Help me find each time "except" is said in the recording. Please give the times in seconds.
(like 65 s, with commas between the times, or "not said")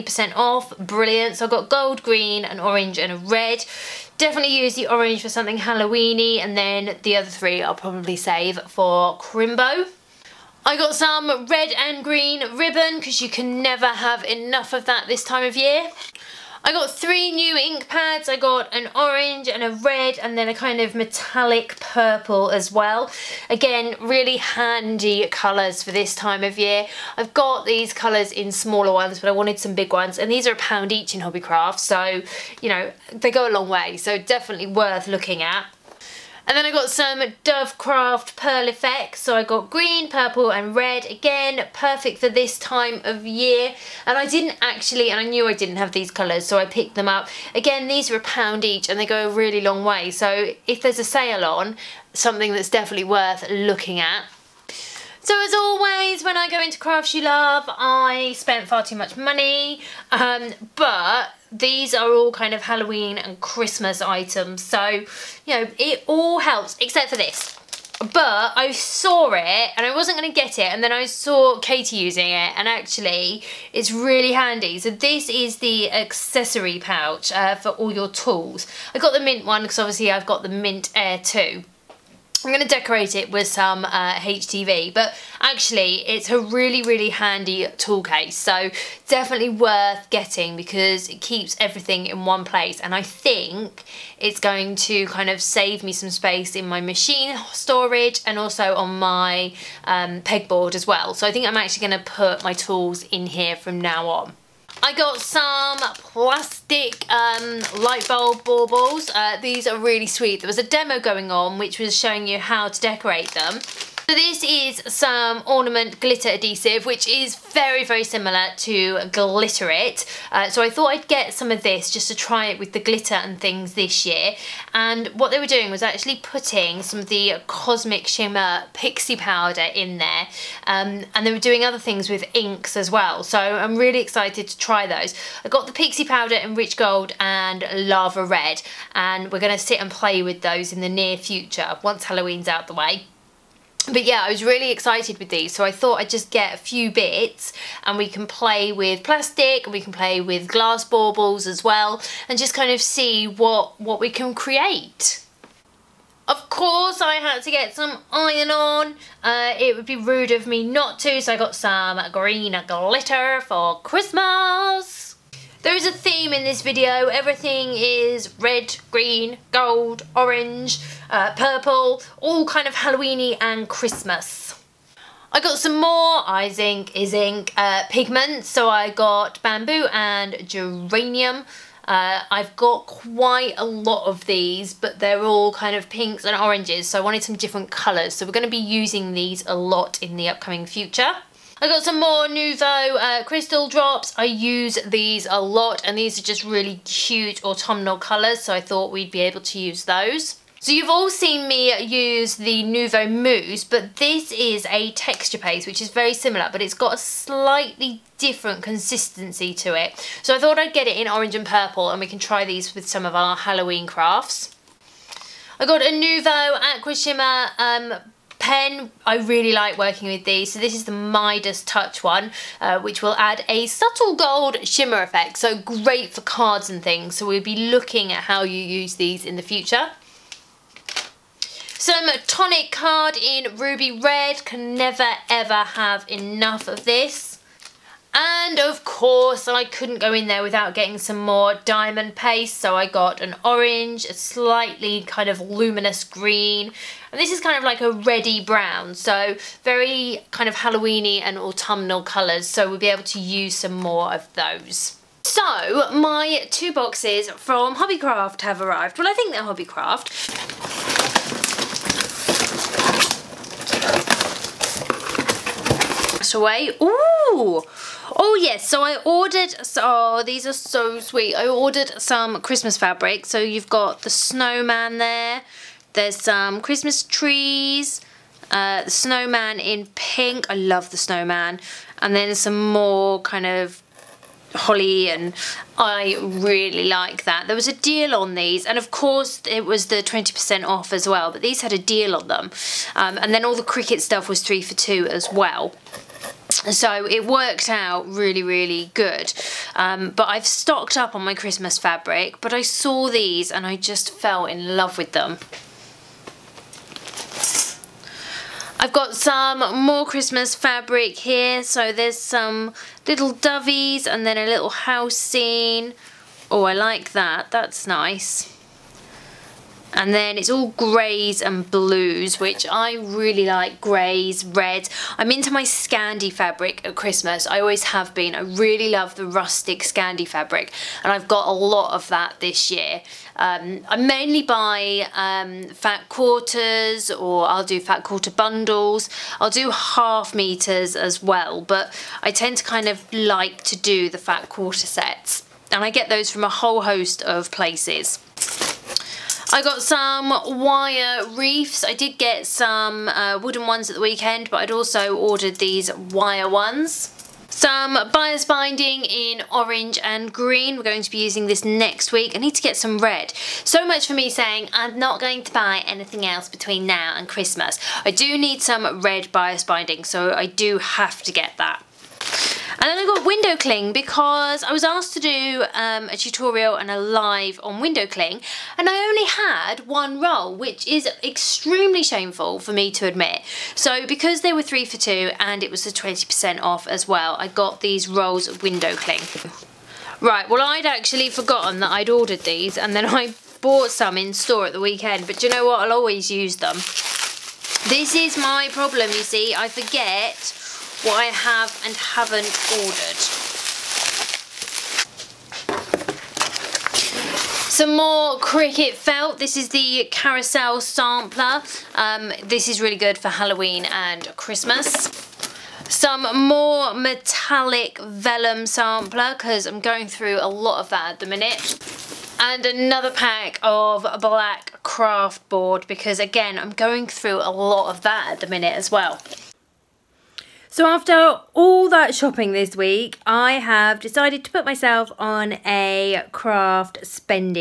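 66 s.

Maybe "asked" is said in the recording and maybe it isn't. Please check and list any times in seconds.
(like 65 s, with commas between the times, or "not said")
374 s.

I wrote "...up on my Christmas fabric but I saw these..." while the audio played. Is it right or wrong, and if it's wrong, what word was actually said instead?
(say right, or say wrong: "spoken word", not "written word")
right.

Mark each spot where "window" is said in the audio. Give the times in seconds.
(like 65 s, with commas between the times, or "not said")
373 s, 377 s, 388 s.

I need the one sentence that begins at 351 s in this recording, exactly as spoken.
I did get some uh, wooden ones at the weekend, but I'd also ordered these wire ones.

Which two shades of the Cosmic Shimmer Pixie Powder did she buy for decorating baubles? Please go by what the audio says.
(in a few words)
Rich Gold and Lava Red.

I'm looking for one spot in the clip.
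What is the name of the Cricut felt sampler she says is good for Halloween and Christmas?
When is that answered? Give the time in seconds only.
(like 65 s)
410 s.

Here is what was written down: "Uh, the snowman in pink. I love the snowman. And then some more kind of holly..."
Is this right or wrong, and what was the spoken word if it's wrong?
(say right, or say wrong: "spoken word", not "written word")
right.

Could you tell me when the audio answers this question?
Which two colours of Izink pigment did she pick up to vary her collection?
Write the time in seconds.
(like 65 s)
179 s.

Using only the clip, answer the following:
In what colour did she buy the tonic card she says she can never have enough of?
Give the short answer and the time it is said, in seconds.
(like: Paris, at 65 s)
Ruby red, at 233 s.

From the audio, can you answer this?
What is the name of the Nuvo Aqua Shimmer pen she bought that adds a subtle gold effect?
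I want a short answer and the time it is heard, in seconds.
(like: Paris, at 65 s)
Midas Touch, at 220 s.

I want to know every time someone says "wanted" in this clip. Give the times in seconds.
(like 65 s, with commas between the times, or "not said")
29 s, 187 s.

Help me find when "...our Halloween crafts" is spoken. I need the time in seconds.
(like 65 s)
213 s.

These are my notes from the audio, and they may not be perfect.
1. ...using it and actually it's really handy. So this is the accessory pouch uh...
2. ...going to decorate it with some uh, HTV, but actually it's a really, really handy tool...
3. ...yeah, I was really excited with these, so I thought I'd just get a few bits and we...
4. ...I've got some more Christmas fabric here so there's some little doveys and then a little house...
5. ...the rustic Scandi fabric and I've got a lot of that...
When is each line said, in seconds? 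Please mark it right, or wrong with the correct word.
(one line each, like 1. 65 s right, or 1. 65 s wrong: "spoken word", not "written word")
1. 71 s right
2. 82 s right
3. 144 s right
4. 308 s right
5. 329 s right.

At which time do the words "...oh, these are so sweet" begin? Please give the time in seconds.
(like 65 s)
269 s.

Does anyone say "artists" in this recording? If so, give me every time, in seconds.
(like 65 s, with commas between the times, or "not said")
not said.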